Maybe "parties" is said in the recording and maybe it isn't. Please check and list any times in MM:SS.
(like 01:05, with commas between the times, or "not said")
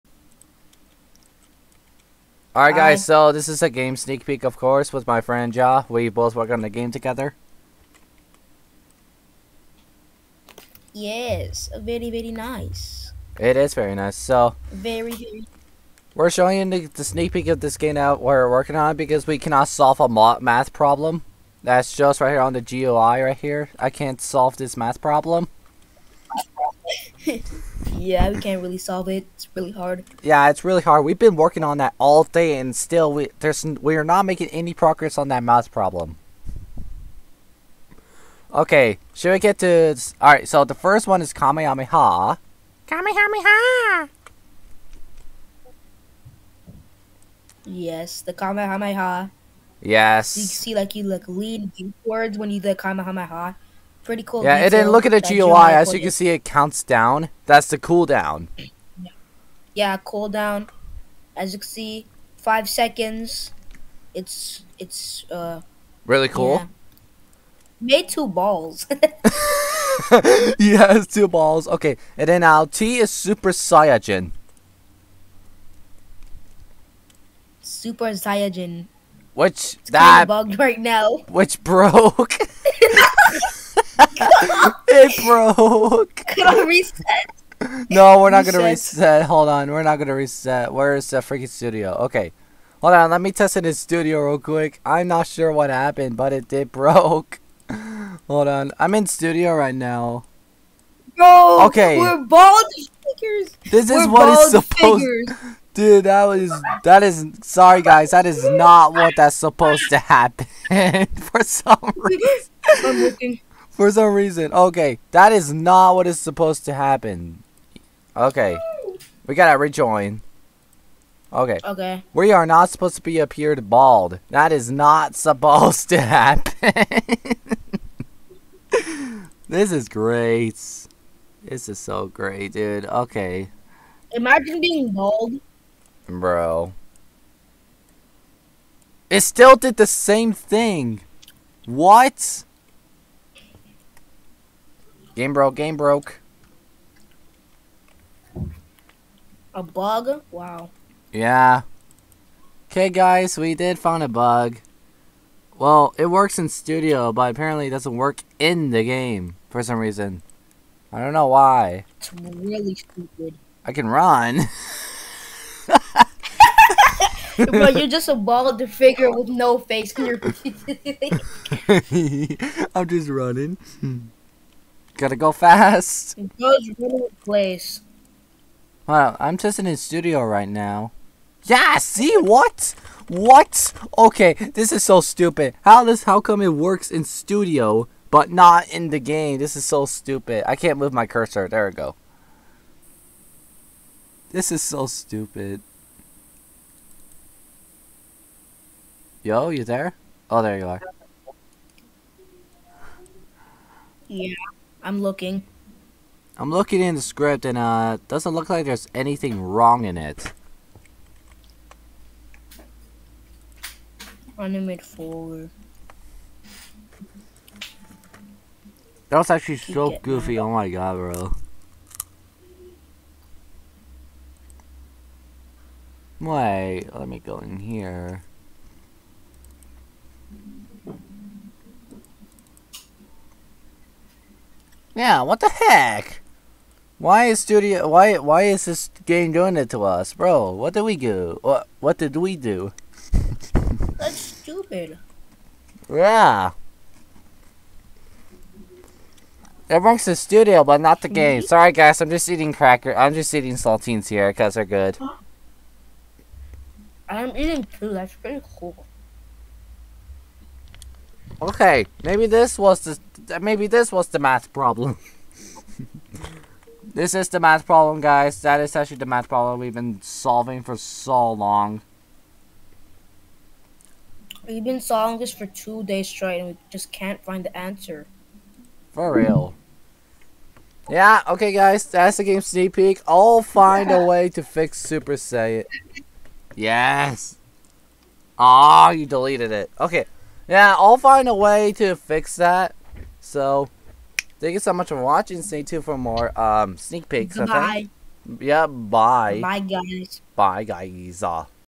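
not said.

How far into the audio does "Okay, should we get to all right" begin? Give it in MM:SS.
00:38.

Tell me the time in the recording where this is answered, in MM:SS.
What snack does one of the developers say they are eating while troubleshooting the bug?
04:13.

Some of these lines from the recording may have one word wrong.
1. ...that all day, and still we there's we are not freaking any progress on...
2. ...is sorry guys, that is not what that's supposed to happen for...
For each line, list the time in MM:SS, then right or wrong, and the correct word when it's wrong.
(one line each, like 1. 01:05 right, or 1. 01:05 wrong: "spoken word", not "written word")
1. 00:31 wrong: "making", not "freaking"
2. 01:47 right.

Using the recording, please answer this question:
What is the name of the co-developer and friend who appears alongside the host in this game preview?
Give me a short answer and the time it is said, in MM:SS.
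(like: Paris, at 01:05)
Ja, at 00:05.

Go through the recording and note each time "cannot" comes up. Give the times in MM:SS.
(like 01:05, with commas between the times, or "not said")
00:19.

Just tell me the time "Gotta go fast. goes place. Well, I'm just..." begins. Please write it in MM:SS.
02:55.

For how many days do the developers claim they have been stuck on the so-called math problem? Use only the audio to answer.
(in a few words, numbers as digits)
2 days.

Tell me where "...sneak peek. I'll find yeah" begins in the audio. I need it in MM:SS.
04:42.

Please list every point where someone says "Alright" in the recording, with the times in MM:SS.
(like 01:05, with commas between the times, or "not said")
00:02.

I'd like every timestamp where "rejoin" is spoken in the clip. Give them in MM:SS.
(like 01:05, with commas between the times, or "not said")
01:59.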